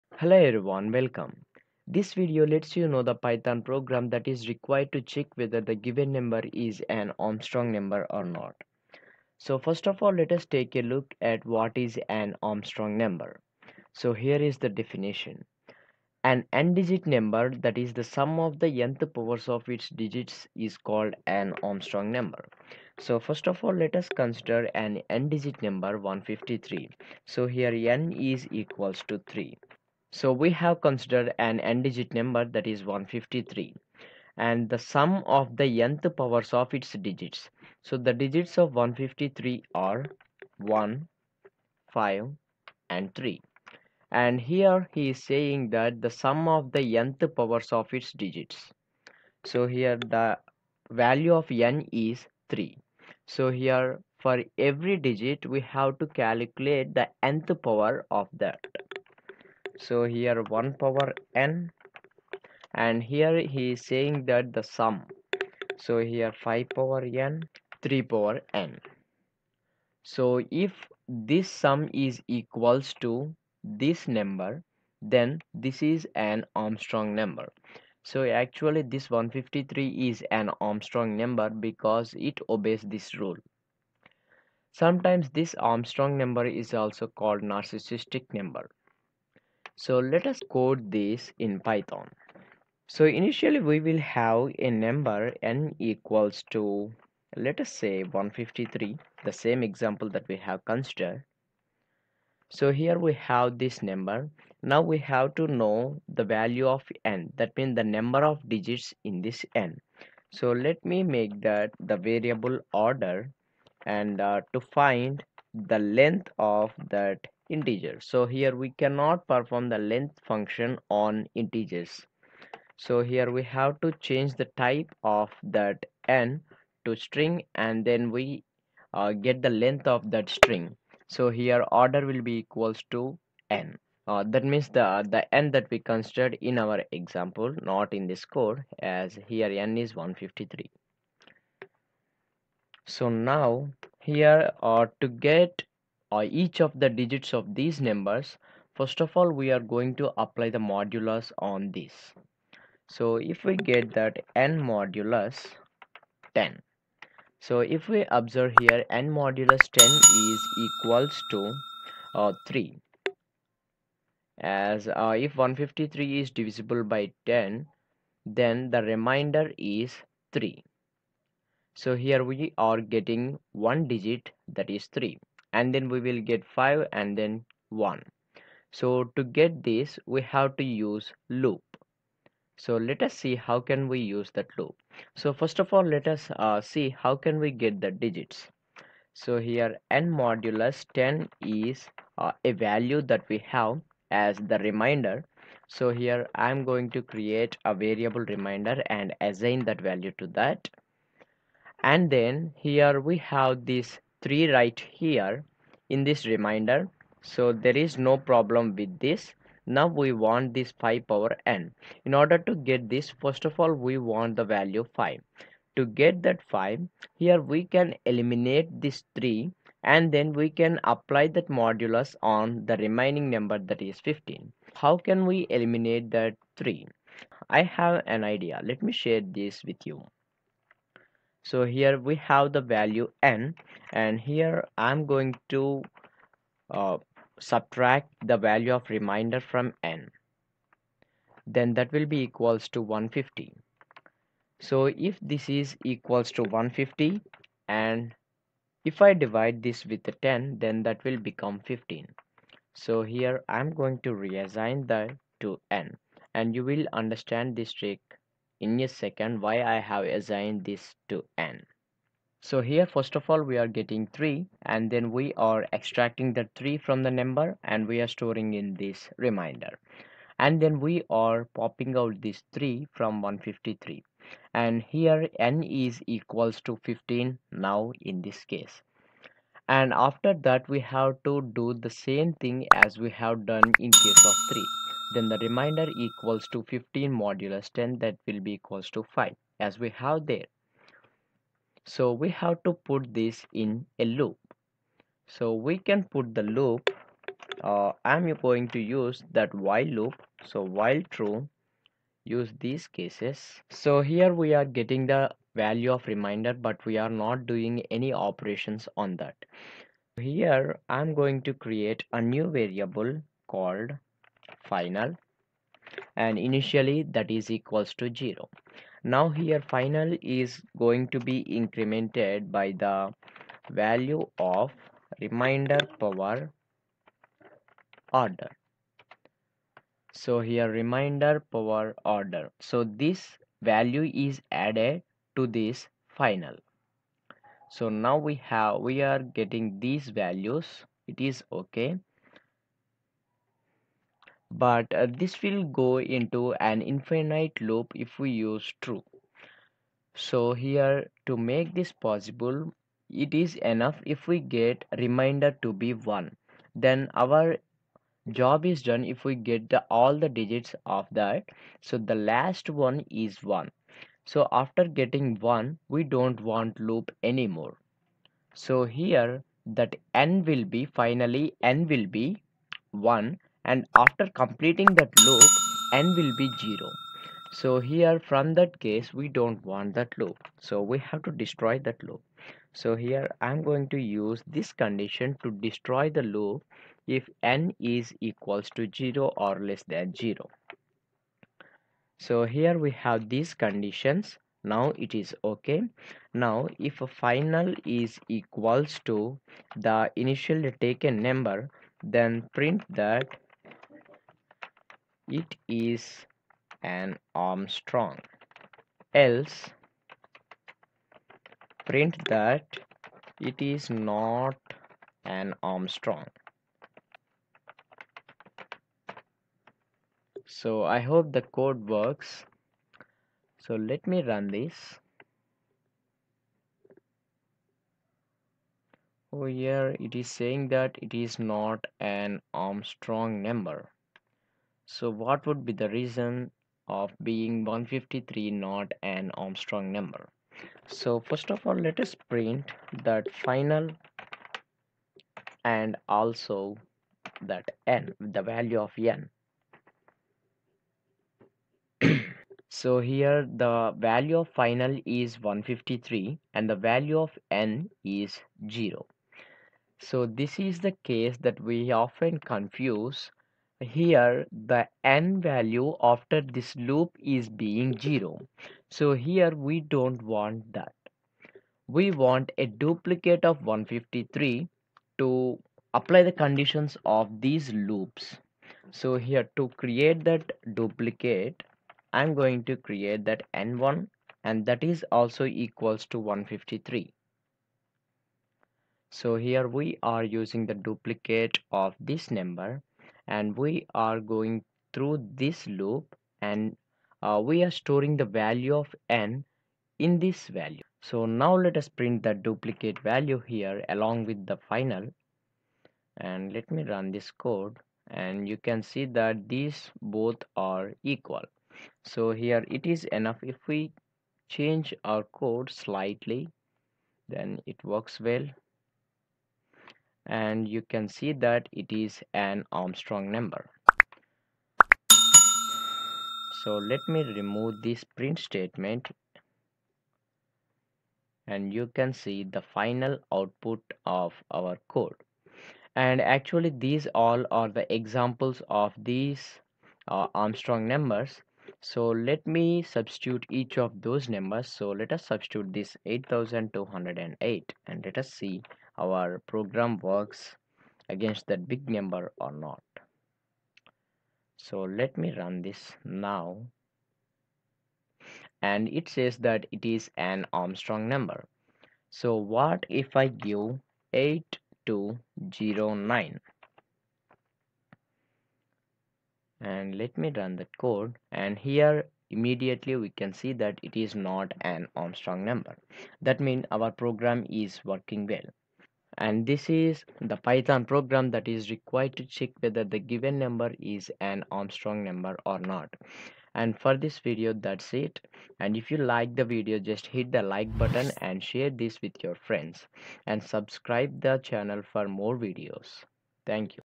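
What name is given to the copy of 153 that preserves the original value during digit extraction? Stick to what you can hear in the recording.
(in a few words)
n1.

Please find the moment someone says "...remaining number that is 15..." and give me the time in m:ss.
3:42.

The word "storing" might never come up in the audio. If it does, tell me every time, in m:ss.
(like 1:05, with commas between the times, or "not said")
4:28, 8:17.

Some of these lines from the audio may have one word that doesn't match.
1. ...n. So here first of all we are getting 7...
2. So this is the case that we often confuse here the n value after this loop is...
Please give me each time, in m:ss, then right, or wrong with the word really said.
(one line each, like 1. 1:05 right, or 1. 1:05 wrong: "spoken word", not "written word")
1. 4:21 wrong: "3", not "7"
2. 7:39 right.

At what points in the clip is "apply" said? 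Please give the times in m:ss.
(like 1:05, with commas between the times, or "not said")
2:30, 3:40, 7:55.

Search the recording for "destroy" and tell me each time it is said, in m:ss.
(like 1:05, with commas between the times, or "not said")
6:21, 6:25.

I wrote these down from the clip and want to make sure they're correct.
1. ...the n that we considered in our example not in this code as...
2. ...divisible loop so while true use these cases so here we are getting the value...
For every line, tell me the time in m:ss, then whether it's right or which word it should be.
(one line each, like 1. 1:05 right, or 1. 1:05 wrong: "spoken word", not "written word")
1. 2:15 right
2. 4:59 wrong: "while", not "divisible".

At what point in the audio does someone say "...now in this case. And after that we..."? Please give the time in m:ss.
4:37.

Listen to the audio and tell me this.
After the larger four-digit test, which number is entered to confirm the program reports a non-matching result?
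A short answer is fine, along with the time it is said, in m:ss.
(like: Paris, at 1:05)
8209, at 9:24.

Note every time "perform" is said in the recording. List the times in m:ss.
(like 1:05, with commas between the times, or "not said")
1:59.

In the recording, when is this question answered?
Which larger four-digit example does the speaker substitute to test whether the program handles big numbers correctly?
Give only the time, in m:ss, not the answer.
9:06.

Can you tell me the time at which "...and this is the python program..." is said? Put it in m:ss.
9:39.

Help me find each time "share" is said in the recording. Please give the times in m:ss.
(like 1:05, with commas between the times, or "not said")
3:49, 9:51.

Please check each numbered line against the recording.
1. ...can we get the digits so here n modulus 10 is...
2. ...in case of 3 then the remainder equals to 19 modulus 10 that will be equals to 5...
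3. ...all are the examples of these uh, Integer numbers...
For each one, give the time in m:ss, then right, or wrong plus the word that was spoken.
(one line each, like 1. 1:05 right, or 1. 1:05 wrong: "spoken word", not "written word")
1. 3:07 right
2. 4:43 wrong: "15", not "19"
3. 8:57 wrong: "Armstrong", not "Integer".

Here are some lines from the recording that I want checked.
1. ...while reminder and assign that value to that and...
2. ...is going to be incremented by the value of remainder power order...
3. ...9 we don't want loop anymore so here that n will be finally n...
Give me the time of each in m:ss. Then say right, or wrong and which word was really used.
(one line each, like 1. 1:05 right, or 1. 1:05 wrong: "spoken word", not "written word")
1. 3:17 wrong: "variable", not "while"
2. 5:20 right
3. 6:05 wrong: "1", not "9".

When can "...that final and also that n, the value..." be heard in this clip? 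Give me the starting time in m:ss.
7:23.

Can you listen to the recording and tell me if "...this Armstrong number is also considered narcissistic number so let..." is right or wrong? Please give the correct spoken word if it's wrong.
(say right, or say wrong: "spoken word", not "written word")
wrong: "called", not "considered".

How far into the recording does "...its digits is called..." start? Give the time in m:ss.
0:19.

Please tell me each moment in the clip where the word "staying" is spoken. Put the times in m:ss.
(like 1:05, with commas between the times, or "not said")
not said.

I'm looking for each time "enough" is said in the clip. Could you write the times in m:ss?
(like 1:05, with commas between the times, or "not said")
5:53, 8:33.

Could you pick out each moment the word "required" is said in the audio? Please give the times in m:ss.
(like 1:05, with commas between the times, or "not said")
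0:04, 9:41.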